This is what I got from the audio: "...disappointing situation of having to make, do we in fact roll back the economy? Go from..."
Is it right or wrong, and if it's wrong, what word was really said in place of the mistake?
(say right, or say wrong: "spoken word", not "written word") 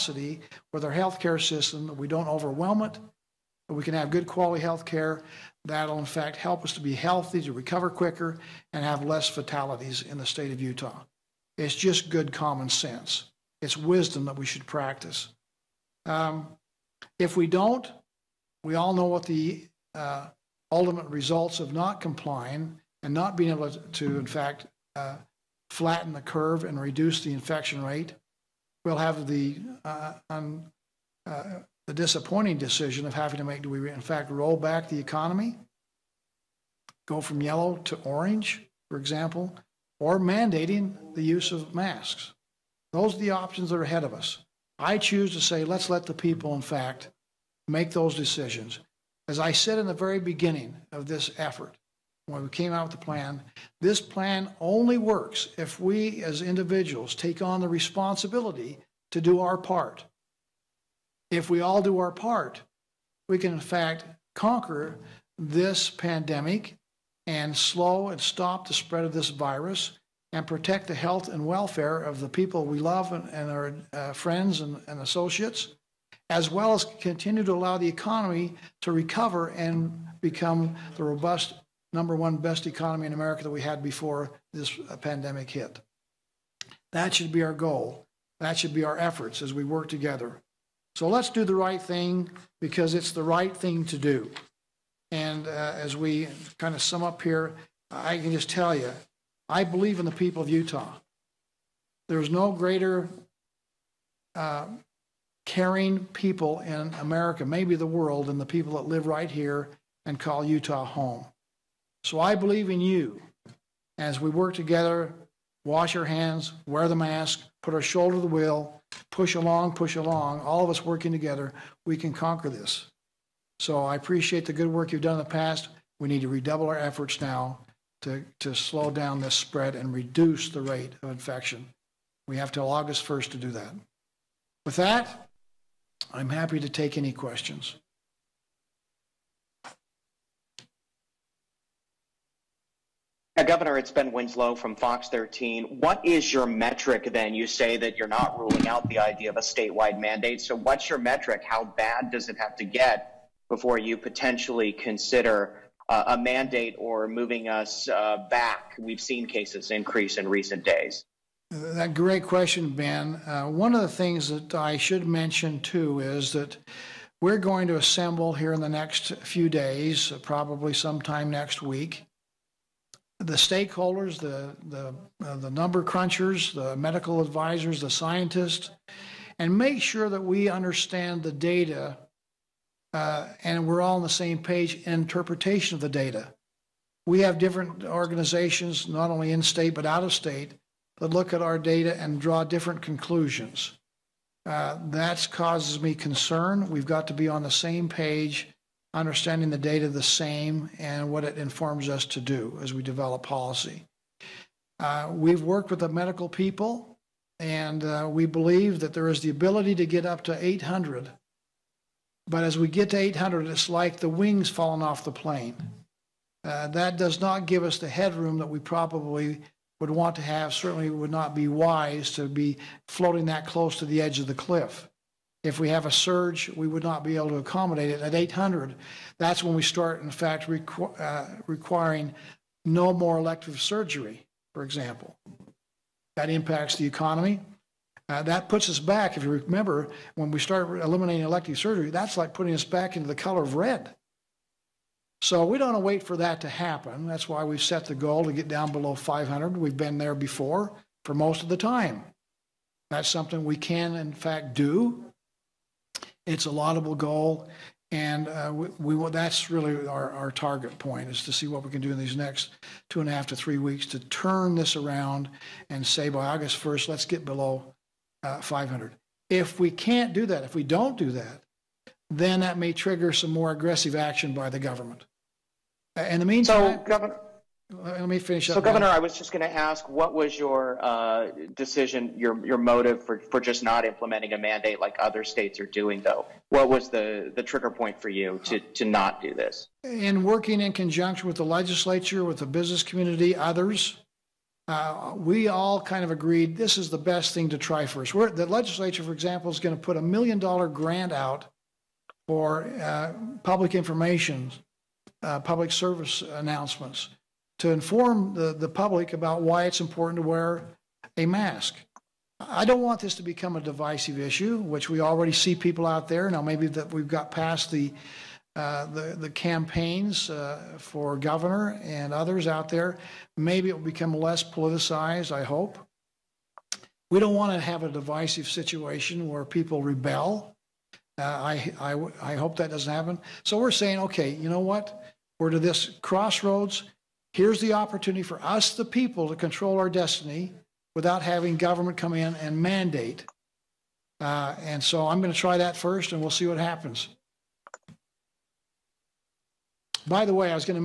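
wrong: "decision", not "situation".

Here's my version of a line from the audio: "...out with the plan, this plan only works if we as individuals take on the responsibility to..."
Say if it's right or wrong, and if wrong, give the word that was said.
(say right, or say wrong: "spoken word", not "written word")
right.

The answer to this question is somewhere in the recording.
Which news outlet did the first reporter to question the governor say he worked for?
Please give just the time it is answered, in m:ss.
2:24.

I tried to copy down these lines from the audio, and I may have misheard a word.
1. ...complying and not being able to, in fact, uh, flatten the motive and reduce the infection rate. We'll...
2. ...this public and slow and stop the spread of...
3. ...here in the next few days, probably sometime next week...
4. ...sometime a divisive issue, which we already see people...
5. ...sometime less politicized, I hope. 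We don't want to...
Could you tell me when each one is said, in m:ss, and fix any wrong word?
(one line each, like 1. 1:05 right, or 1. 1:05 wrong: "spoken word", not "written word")
1. 0:22 wrong: "curve", not "motive"
2. 1:05 wrong: "pandemic", not "public"
3. 2:48 right
4. 5:13 wrong: "become", not "sometime"
5. 5:23 wrong: "become", not "sometime".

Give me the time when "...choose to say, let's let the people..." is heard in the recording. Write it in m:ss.
0:44.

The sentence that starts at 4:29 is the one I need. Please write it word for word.
If we can't do that, if we don't do that, then that may trigger some more aggressive action by the government.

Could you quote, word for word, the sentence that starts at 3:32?
But as we get to 800, it's like the wings falling off the plane.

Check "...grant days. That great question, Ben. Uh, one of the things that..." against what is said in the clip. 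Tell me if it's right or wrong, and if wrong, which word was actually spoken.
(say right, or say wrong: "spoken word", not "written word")
wrong: "recent", not "grant".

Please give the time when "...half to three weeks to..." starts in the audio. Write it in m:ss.
4:23.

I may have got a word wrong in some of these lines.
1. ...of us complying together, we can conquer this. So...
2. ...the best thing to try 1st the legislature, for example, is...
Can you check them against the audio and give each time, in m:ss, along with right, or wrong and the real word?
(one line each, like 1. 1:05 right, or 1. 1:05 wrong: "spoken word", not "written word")
1. 2:00 wrong: "working", not "complying"
2. 4:56 right.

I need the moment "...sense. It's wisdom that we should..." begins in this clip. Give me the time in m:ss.
0:12.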